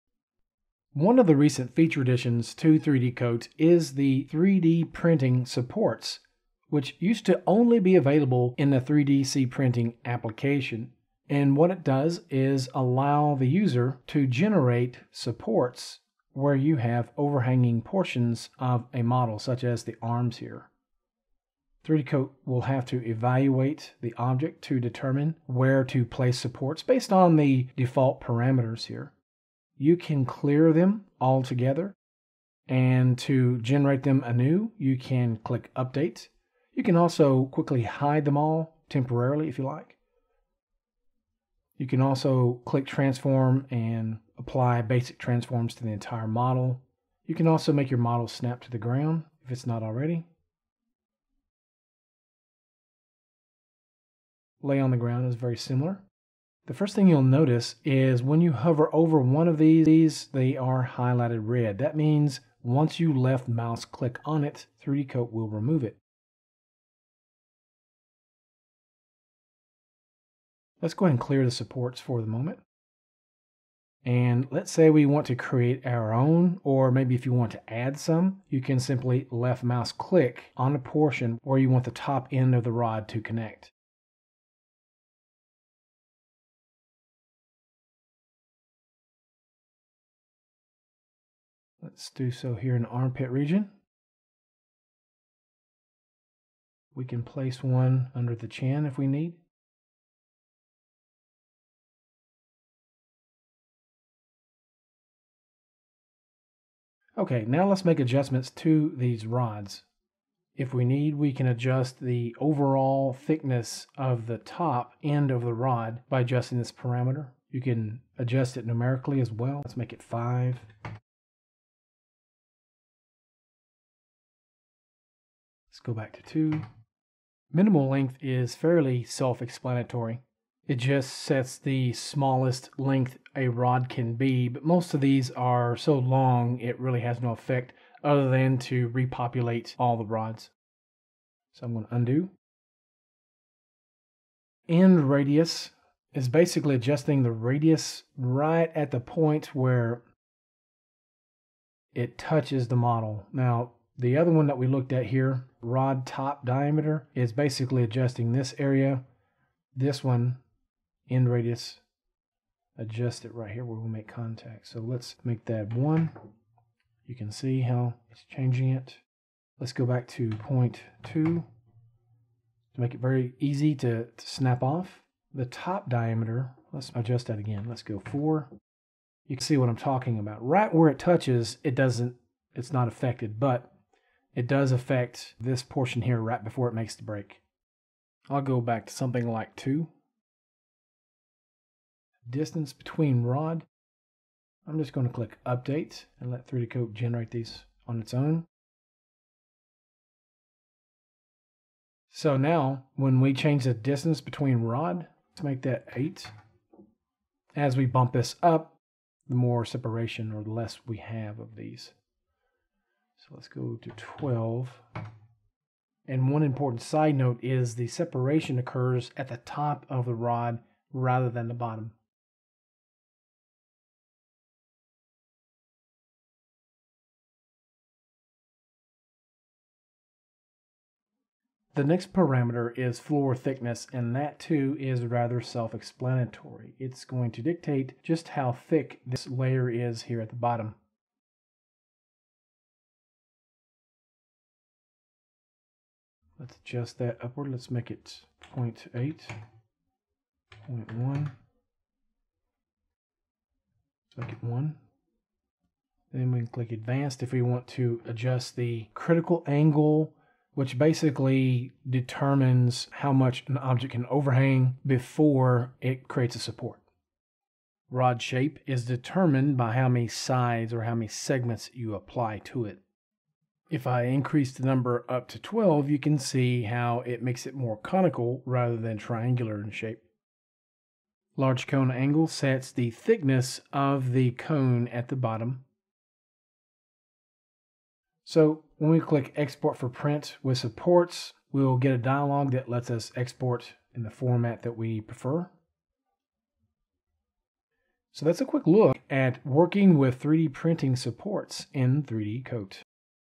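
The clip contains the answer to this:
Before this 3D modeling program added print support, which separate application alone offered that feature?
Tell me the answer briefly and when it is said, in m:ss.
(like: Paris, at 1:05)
3DC printing application, at 0:08.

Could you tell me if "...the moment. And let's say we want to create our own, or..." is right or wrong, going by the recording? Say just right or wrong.
right.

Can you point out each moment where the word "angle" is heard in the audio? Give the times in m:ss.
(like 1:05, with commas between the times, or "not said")
4:19, 4:41.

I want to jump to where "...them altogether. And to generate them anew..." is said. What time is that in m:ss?
0:30.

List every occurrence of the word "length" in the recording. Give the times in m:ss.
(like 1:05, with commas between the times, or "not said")
2:07, 2:12.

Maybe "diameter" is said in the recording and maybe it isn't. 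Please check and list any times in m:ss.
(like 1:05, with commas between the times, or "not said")
2:36, 2:55.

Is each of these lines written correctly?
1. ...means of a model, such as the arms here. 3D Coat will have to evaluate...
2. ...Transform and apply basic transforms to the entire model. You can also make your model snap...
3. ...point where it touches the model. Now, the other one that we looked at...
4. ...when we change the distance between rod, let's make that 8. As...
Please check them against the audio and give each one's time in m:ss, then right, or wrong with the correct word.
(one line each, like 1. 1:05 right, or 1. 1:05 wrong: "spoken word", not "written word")
1. 0:17 wrong: "portions", not "means"
2. 0:42 right
3. 2:28 right
4. 3:22 right.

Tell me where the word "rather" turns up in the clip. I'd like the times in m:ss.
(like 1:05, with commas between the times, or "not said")
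3:40, 3:55, 4:38.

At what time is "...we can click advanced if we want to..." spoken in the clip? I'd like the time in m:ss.
4:16.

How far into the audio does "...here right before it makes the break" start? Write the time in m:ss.
3:06.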